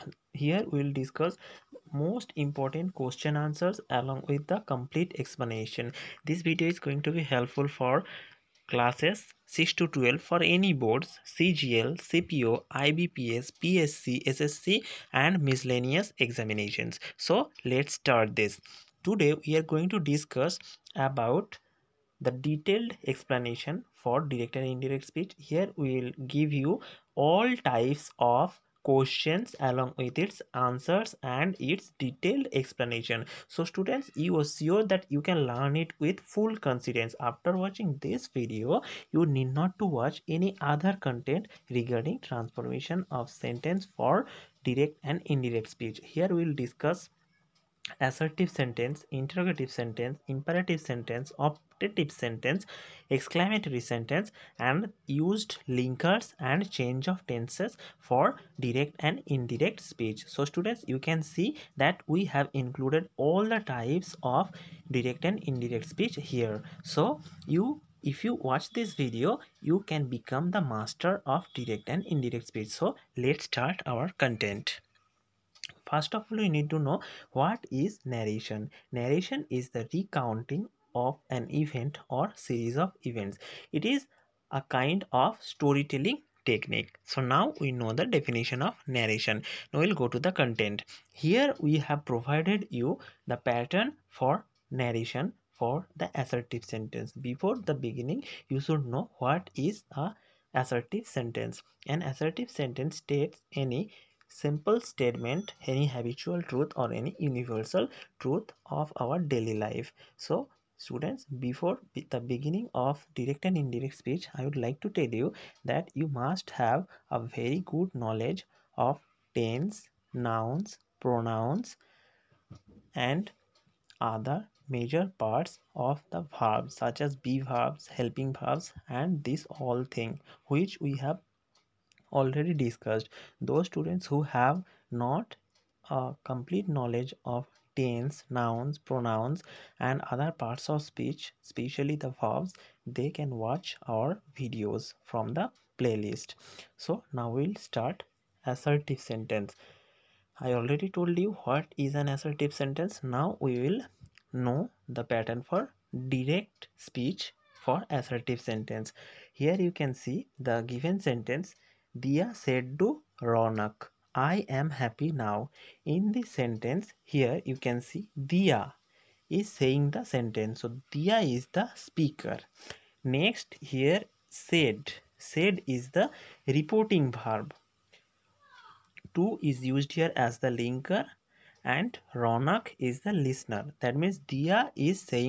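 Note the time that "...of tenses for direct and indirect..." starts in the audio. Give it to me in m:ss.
0:57.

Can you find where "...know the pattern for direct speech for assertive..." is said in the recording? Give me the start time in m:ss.
2:34.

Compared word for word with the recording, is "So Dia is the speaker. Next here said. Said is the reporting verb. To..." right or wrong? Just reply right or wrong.
right.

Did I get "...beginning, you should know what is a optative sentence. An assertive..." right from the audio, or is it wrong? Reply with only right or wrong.
wrong.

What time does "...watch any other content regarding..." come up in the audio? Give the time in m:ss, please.
0:39.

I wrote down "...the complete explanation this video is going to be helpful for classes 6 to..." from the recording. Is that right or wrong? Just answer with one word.
right.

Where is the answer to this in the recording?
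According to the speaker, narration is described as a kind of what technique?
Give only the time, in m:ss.
1:25.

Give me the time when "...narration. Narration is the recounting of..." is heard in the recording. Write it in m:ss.
1:18.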